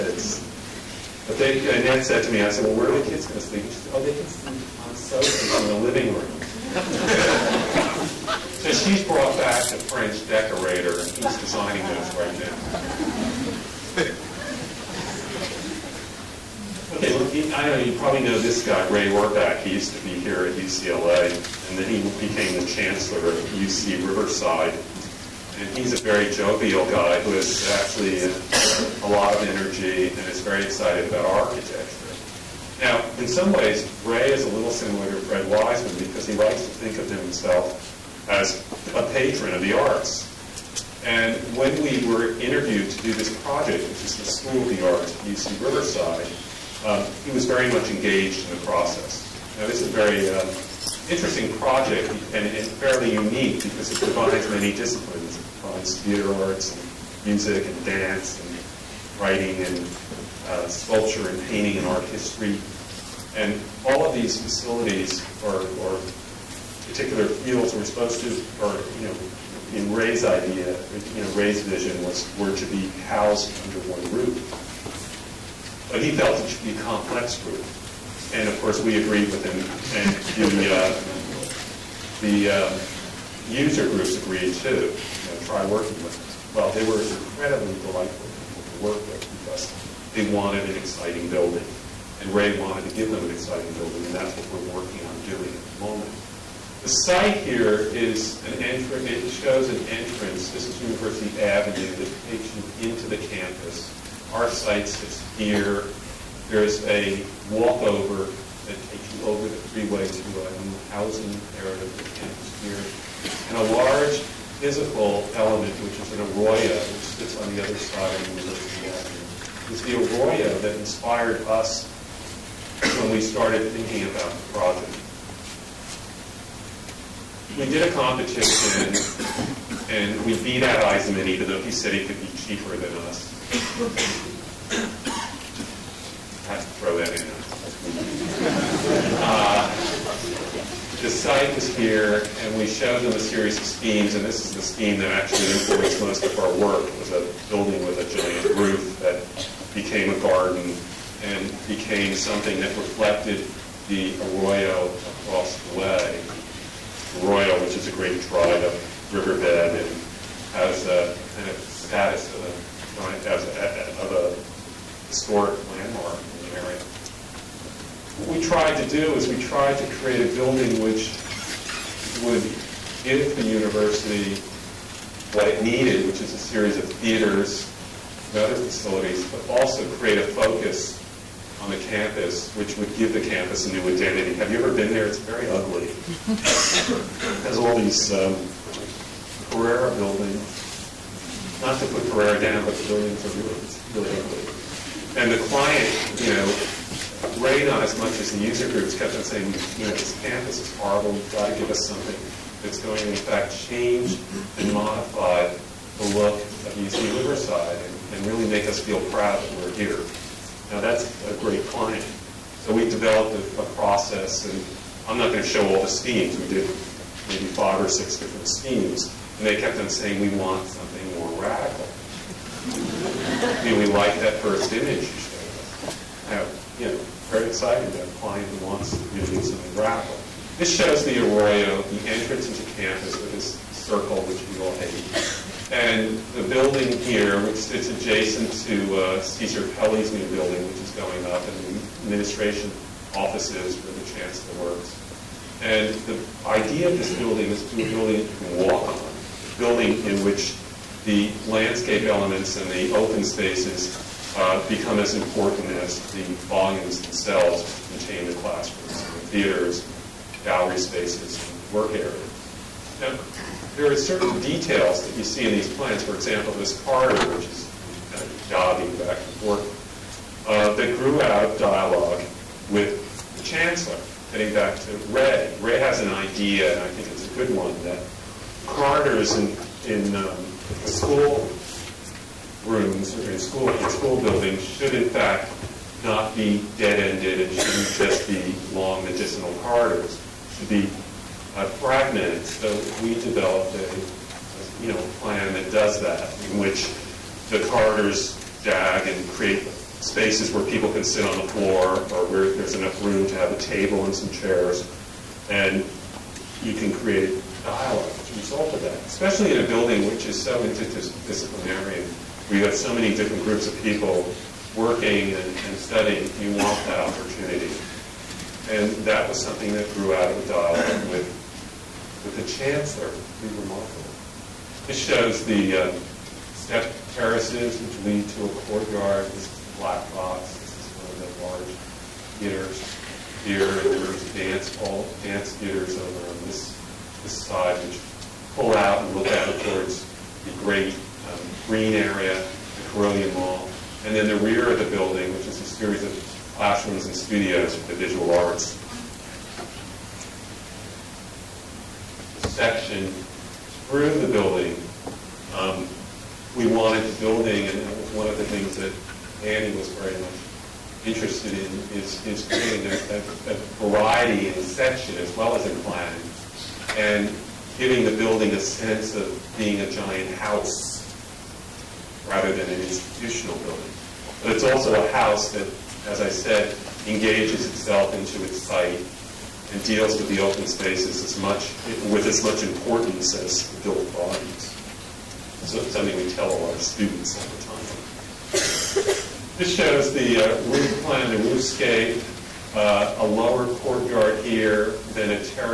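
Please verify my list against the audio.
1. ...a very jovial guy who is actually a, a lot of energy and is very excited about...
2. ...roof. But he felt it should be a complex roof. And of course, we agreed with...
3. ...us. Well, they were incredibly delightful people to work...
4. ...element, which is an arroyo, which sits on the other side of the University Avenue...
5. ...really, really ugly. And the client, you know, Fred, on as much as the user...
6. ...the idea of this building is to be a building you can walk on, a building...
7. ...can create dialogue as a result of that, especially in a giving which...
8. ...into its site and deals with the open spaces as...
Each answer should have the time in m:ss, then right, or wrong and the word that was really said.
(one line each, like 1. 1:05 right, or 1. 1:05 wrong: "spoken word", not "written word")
1. 0:25 right
2. 1:14 right
3. 1:26 right
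4. 1:55 right
5. 3:13 wrong: "Ray", not "Fred"
6. 4:06 right
7. 5:06 wrong: "building", not "giving"
8. 6:18 right.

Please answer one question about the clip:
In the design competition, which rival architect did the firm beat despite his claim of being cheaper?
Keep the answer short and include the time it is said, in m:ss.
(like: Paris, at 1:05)
Eisenman, at 2:10.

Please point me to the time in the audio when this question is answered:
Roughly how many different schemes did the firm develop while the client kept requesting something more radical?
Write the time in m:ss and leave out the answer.
3:37.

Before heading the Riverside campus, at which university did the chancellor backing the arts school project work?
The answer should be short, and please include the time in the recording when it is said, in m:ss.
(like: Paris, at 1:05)
UCLA, at 0:20.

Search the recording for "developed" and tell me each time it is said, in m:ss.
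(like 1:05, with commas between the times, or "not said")
3:32, 4:53.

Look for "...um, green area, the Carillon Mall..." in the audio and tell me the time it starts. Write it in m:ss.
5:41.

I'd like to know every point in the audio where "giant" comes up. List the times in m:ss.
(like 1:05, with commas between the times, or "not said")
2:28, 6:09.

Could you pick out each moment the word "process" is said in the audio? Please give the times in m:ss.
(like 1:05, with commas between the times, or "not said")
0:48, 3:33.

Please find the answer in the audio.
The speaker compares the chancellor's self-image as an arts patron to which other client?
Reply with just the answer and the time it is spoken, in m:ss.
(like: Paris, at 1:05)
Fred Wiseman, at 0:35.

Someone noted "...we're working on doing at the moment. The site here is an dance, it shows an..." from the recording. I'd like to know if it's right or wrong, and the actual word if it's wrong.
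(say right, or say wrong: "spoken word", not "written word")
wrong: "entrance", not "dance".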